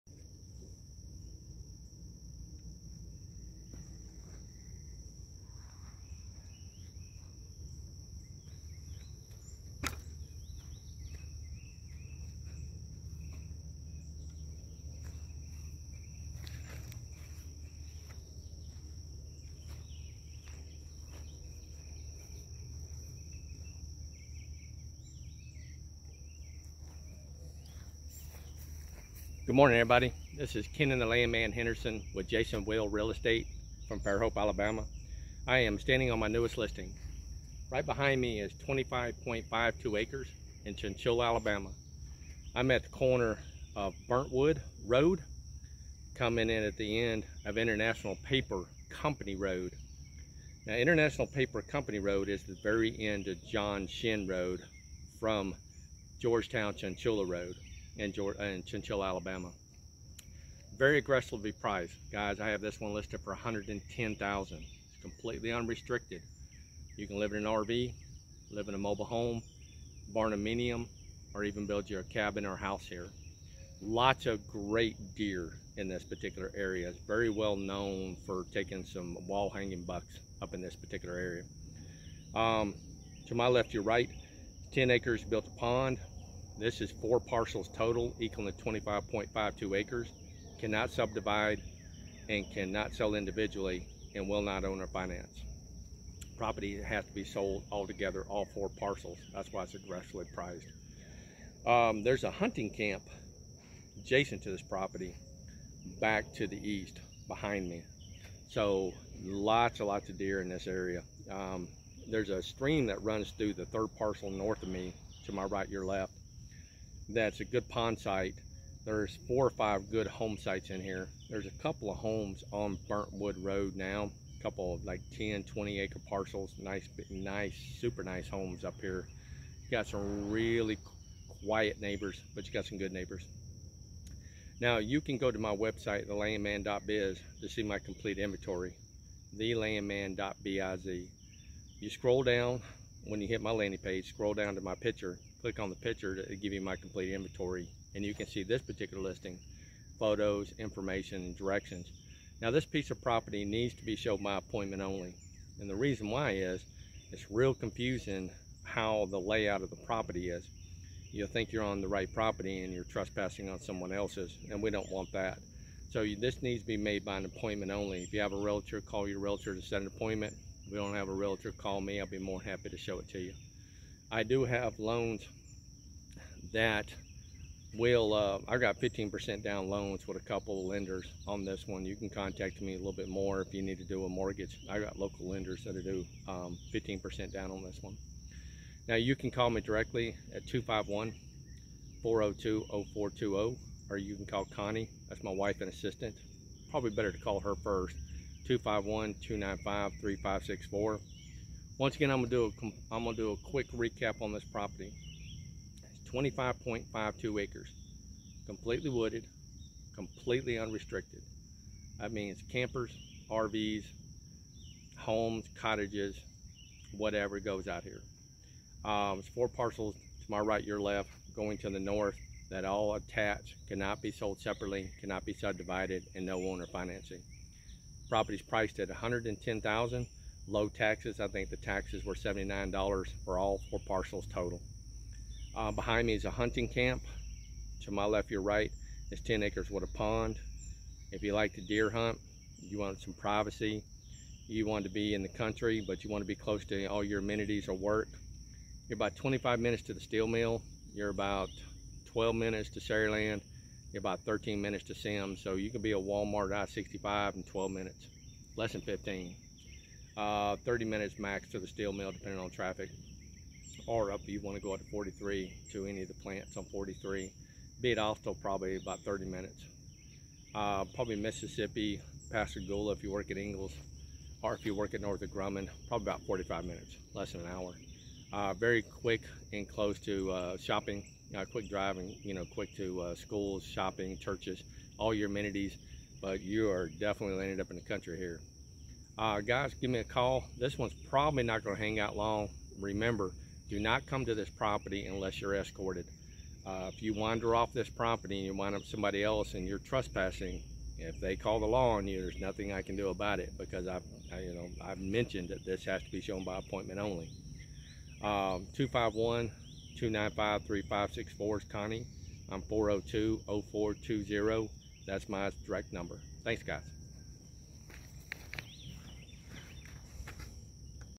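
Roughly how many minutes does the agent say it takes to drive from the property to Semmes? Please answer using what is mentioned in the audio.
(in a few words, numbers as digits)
13 minutes.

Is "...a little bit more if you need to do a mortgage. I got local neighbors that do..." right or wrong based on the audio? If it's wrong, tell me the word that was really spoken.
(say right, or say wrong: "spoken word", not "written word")
wrong: "lenders", not "neighbors".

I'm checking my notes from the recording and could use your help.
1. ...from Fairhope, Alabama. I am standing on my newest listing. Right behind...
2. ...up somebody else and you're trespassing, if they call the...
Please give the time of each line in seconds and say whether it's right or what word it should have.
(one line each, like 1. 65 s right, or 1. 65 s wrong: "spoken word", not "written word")
1. 33 s right
2. 298 s right.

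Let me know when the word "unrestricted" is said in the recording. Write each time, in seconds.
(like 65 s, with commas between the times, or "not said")
65 s, 210 s.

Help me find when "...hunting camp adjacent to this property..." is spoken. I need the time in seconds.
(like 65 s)
102 s.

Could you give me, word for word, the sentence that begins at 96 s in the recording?
Property has to be sold altogether, all four parcels.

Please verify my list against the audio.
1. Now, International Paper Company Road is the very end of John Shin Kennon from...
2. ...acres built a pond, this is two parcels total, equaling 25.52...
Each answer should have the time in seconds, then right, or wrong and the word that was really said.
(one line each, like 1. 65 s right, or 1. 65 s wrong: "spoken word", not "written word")
1. 50 s wrong: "Road", not "Kennon"
2. 84 s wrong: "four", not "two".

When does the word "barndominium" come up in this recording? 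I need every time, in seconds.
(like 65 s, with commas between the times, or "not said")
70 s.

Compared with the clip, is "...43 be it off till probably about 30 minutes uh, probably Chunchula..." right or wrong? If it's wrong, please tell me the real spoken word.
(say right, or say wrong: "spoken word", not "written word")
wrong: "Mississippi", not "Chunchula".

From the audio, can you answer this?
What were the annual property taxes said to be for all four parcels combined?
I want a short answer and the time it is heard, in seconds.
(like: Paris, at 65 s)
$79, at 232 s.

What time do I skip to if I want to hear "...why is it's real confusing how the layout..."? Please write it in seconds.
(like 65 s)
156 s.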